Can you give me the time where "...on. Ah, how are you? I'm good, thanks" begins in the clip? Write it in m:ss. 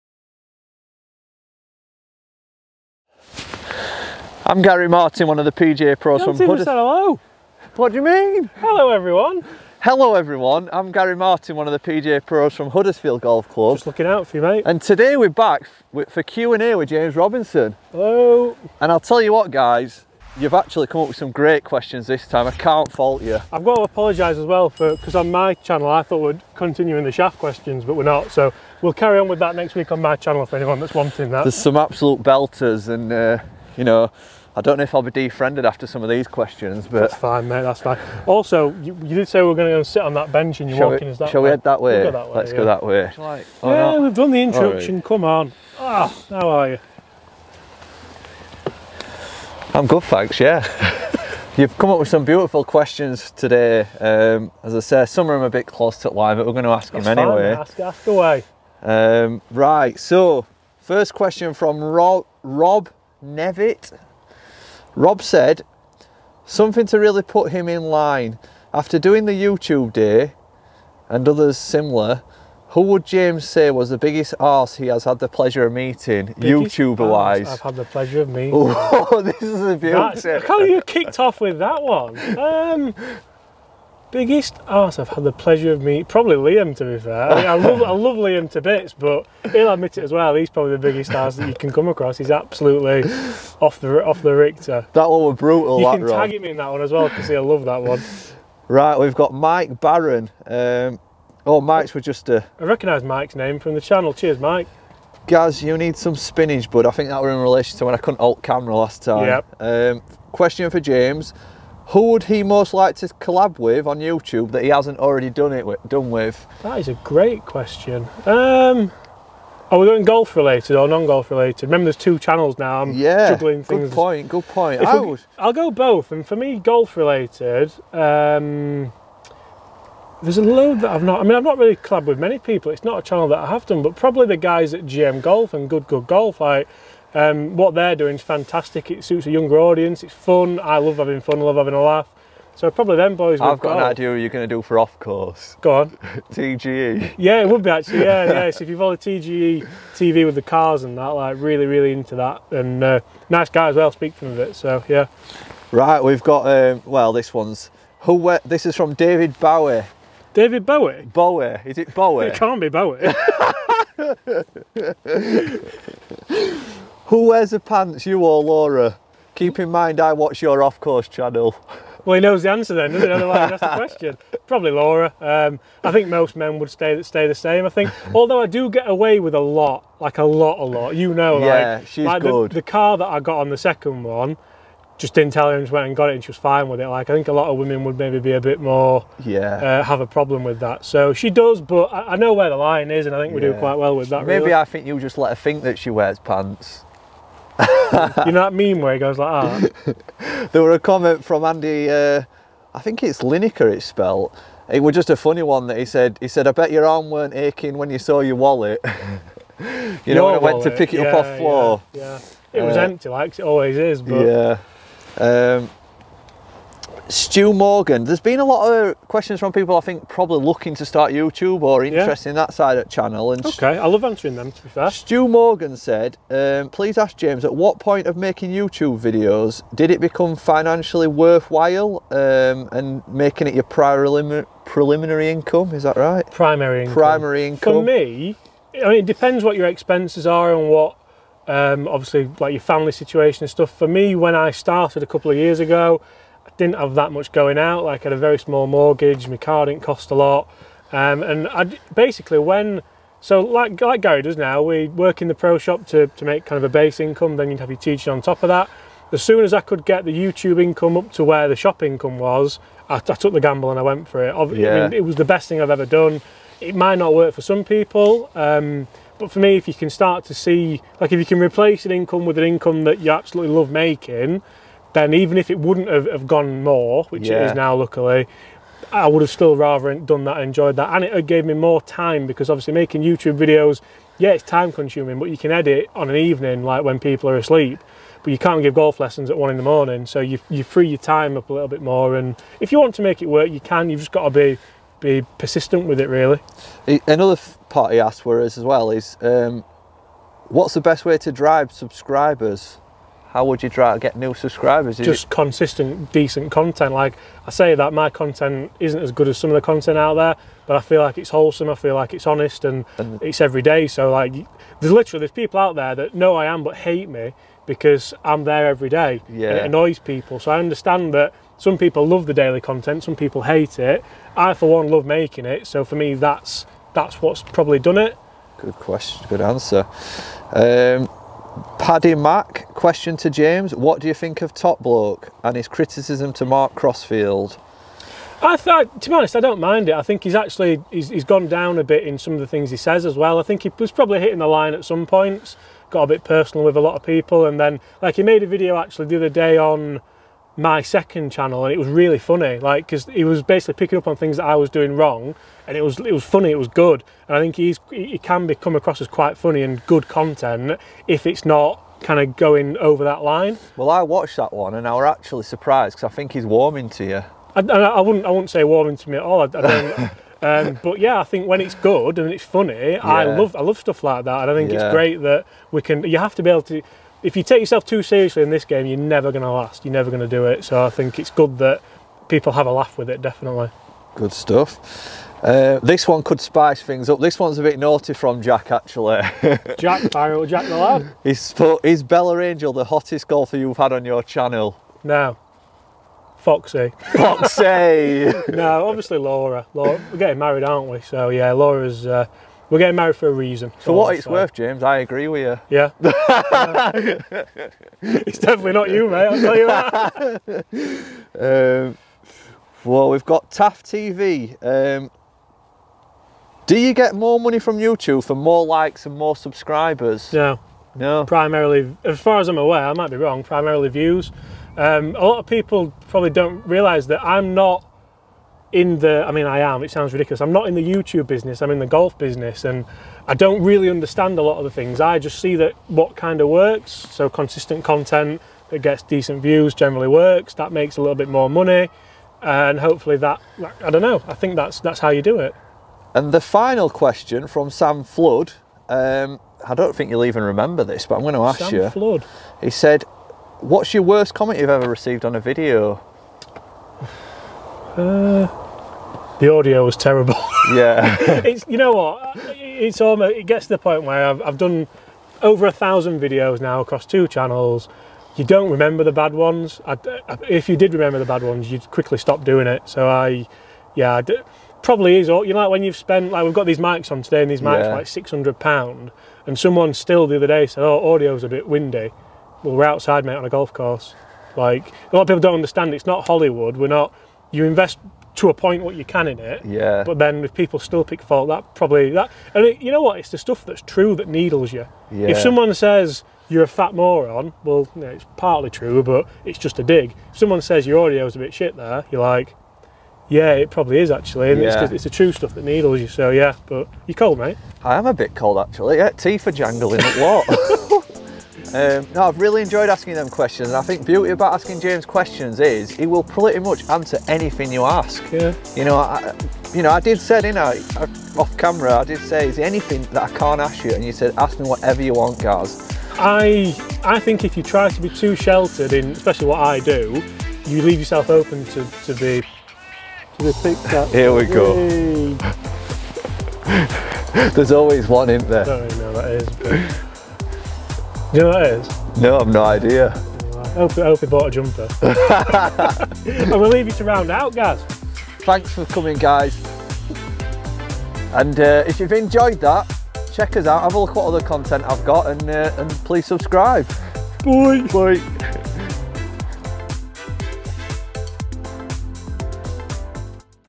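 0:45.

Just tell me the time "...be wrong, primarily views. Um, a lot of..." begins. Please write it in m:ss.
7:03.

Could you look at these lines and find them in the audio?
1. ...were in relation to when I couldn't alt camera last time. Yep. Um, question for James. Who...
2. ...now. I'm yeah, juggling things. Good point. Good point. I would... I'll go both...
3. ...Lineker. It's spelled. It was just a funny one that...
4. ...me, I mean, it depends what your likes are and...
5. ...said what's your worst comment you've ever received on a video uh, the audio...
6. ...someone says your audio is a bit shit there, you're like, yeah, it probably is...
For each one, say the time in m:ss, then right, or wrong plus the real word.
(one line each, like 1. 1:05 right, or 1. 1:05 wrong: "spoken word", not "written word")
1. 1:47 right
2. 2:02 right
3. 3:23 right
4. 3:57 wrong: "expenses", not "likes"
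5. 7:32 right
6. 8:20 right.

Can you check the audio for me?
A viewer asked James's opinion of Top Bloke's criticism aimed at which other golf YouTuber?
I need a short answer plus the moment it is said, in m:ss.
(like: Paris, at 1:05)
Mark Crossfield, at 5:36.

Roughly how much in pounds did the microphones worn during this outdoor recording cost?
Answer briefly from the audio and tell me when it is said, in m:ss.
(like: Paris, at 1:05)
600 pounds, at 7:58.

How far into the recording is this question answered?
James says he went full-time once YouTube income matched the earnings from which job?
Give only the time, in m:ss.
4:21.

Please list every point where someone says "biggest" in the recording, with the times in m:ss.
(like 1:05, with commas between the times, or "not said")
1:13, 1:24, 1:30.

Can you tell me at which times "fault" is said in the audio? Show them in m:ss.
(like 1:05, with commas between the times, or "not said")
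0:22, 8:11.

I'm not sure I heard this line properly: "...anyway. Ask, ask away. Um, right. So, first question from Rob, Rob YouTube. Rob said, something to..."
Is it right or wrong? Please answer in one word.
wrong.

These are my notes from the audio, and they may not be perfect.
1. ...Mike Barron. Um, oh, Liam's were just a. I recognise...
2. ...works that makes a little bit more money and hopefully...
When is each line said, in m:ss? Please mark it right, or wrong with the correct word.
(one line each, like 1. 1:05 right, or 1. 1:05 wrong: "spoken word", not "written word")
1. 1:39 wrong: "Mike", not "Liam"
2. 7:20 right.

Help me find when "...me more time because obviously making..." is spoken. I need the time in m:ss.
4:41.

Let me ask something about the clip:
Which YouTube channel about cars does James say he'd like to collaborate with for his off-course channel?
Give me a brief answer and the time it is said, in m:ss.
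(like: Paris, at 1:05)
TGE TV, at 2:28.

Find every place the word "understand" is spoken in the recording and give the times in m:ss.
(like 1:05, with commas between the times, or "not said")
5:20, 7:13, 8:05.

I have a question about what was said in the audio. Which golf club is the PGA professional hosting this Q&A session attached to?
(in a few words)
Huddersfield Golf Club.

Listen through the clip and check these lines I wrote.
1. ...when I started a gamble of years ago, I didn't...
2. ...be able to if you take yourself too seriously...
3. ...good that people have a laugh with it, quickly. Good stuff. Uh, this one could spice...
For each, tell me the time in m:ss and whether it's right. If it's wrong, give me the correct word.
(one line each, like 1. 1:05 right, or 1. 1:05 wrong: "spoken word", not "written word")
1. 4:04 wrong: "couple", not "gamble"
2. 6:16 right
3. 6:21 wrong: "definitely", not "quickly".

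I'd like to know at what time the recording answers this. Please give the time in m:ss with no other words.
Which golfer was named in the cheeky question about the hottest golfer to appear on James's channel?
6:32.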